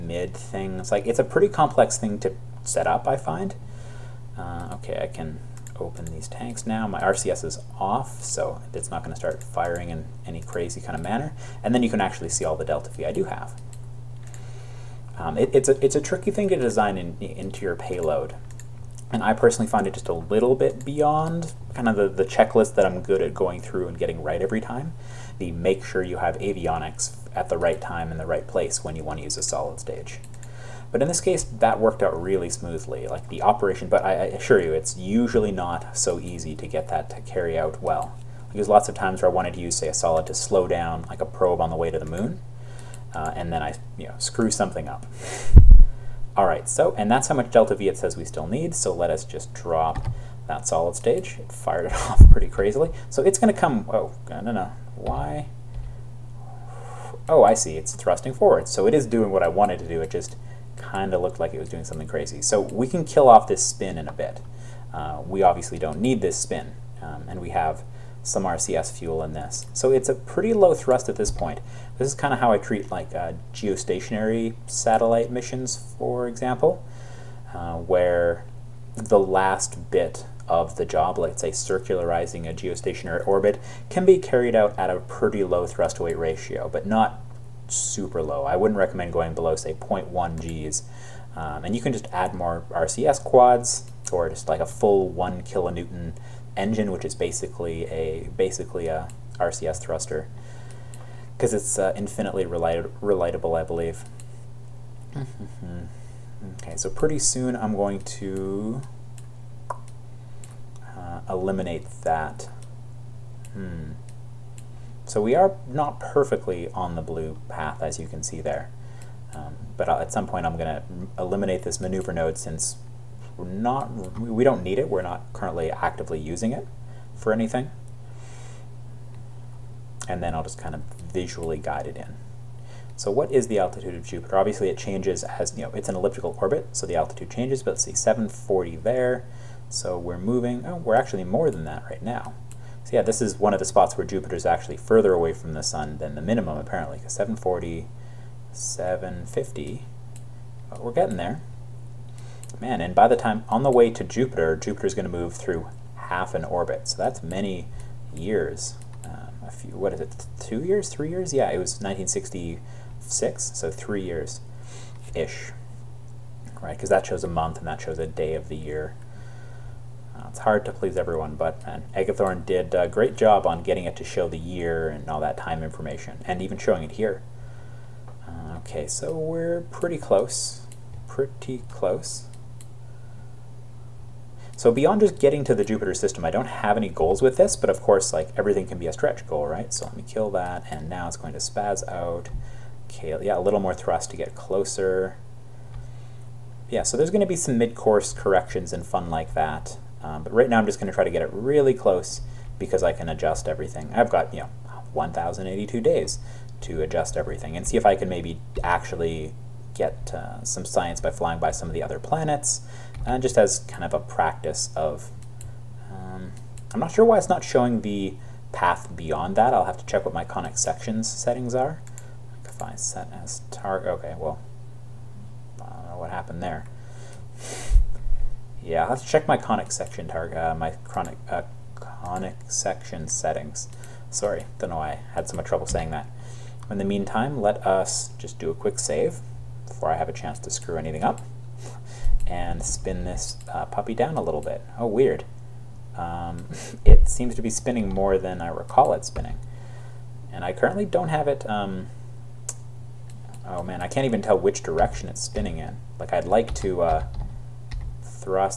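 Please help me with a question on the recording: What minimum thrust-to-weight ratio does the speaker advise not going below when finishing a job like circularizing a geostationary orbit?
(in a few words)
0.1 Gs.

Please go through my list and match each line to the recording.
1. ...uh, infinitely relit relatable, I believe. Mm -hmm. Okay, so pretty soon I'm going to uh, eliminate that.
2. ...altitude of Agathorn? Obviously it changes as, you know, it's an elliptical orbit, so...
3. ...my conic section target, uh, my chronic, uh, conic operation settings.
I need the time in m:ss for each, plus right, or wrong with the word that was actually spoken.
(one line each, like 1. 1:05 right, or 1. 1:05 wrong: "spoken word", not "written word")
1. 1:41 right
2. 2:13 wrong: "Jupiter", not "Agathorn"
3. 3:49 wrong: "section", not "operation".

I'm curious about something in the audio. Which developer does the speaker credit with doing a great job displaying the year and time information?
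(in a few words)
Agathorn.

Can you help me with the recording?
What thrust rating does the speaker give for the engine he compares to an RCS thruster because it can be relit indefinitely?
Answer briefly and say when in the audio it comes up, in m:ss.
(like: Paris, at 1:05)
1 kilonewton, at 1:35.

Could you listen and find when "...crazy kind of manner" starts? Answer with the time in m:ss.
0:10.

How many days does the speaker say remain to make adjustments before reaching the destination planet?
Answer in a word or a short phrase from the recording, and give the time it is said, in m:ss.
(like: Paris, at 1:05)
1,082, at 3:24.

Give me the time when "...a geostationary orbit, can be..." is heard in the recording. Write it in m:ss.
1:22.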